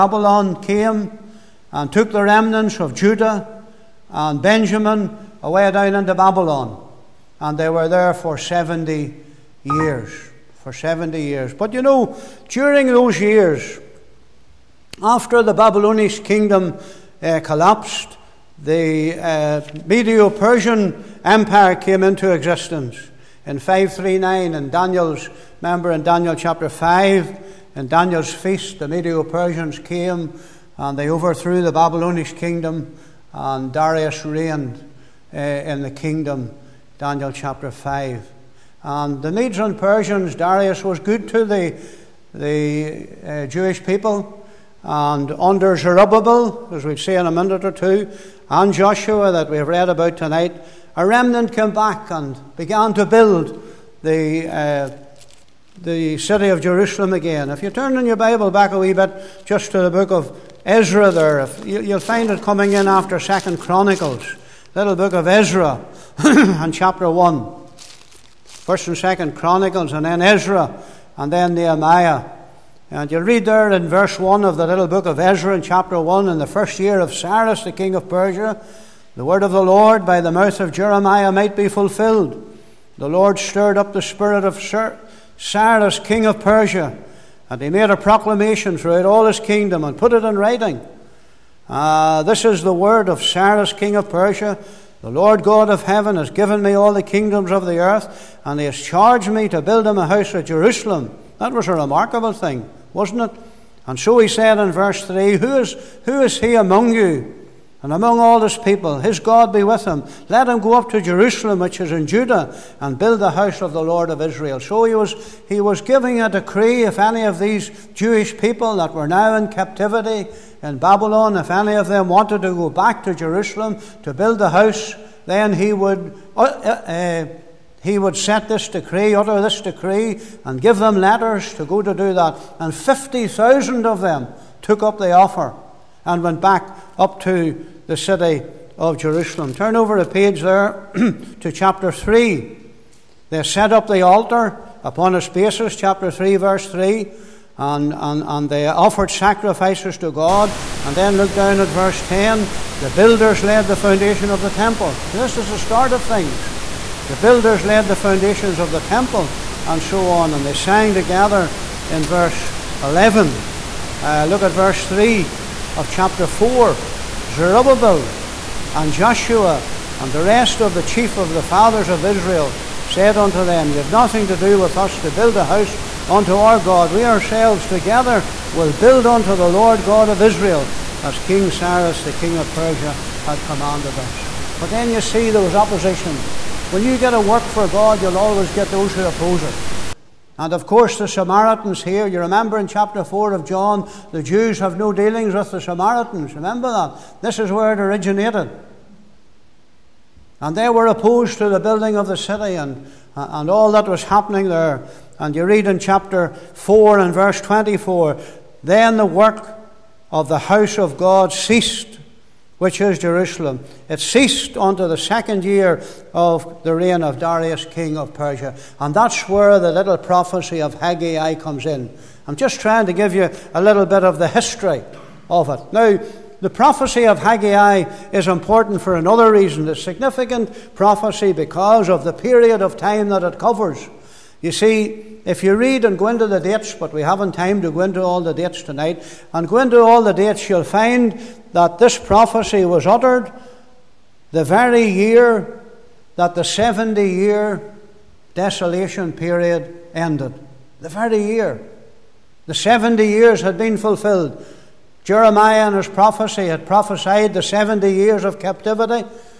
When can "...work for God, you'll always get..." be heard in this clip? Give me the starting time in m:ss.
3:07.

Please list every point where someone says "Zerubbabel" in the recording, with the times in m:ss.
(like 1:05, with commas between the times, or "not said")
0:45, 2:47.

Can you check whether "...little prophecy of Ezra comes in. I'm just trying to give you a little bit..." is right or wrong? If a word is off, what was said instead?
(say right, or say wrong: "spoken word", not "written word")
wrong: "Haggai", not "Ezra".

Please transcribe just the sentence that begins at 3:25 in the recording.
And you read in chapter 4 and verse 24 Then the work of the house of God ceased which is Jerusalem.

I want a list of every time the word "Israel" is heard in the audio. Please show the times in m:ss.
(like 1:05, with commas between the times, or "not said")
1:54, 2:52, 3:00.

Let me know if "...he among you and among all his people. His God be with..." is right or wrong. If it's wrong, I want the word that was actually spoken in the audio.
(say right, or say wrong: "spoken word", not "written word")
right.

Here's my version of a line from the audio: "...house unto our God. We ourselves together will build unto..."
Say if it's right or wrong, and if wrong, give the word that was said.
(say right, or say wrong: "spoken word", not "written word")
right.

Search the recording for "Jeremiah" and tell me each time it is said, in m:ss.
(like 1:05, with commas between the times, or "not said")
1:20, 4:15.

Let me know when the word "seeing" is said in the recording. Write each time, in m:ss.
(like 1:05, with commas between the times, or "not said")
not said.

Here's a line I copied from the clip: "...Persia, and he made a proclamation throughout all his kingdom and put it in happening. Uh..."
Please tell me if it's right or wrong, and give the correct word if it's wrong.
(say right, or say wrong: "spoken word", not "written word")
wrong: "writing", not "happening".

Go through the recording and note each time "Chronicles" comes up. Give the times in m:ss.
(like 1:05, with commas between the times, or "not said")
1:03, 1:09.